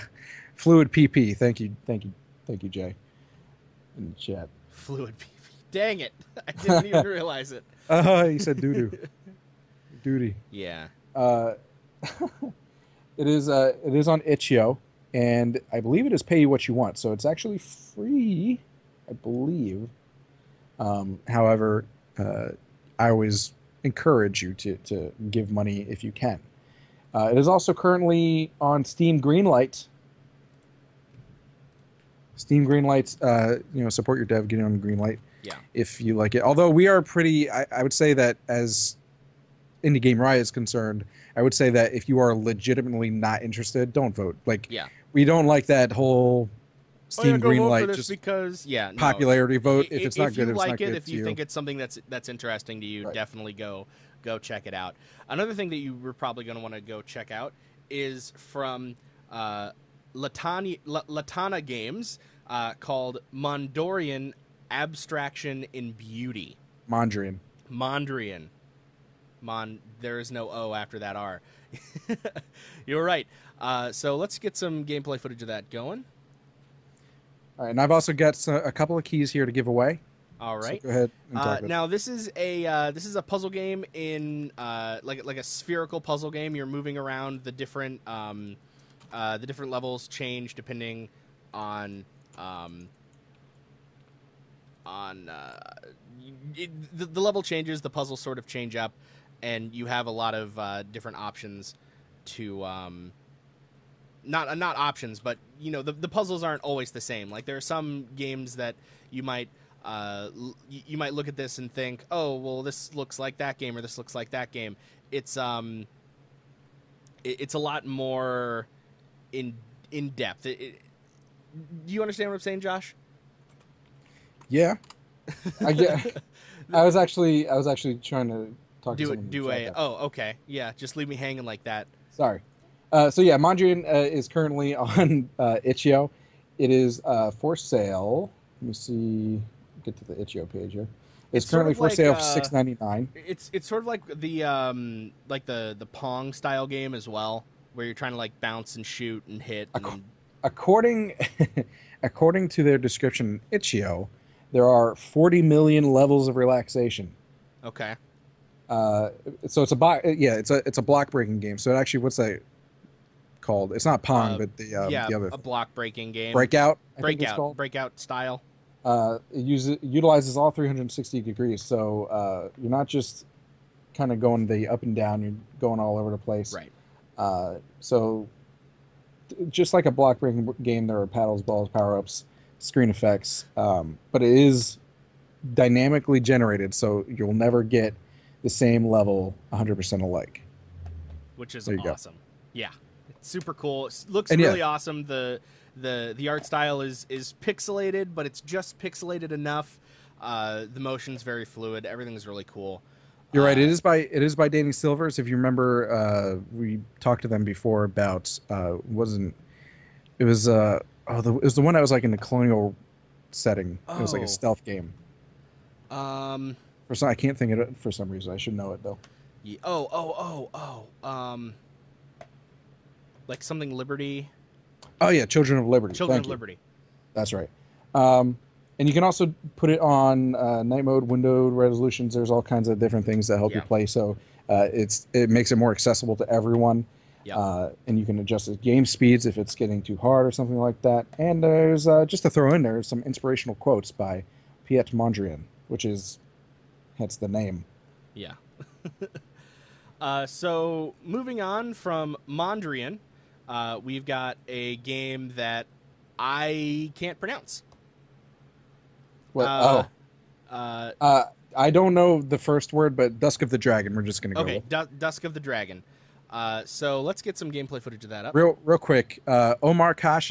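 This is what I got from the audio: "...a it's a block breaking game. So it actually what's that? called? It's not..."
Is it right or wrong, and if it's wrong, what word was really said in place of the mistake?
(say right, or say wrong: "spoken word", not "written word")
right.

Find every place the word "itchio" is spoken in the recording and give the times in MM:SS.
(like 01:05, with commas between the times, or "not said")
00:14, 02:15, 02:20, 02:33.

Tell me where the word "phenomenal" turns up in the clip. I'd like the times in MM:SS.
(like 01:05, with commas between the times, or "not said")
not said.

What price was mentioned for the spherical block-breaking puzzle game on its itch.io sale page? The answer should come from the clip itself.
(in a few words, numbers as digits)
$6.99.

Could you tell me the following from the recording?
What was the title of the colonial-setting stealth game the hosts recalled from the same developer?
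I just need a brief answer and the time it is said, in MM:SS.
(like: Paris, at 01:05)
Children of Liberty, at 03:45.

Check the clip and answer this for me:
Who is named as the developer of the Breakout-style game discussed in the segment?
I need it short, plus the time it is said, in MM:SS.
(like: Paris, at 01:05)
Danny Silvers, at 03:24.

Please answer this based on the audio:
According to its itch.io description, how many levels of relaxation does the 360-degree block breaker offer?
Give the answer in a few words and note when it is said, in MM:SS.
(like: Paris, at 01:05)
40 million, at 02:34.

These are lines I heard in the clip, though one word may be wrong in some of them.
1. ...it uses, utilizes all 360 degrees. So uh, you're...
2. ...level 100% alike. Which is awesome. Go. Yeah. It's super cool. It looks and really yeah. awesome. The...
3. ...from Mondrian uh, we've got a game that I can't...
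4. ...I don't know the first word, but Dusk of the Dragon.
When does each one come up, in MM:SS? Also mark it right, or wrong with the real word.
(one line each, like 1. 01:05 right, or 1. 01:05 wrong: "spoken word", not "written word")
1. 02:49 right
2. 03:08 right
3. 04:11 right
4. 04:21 right.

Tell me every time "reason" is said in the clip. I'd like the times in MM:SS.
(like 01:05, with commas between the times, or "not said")
03:38.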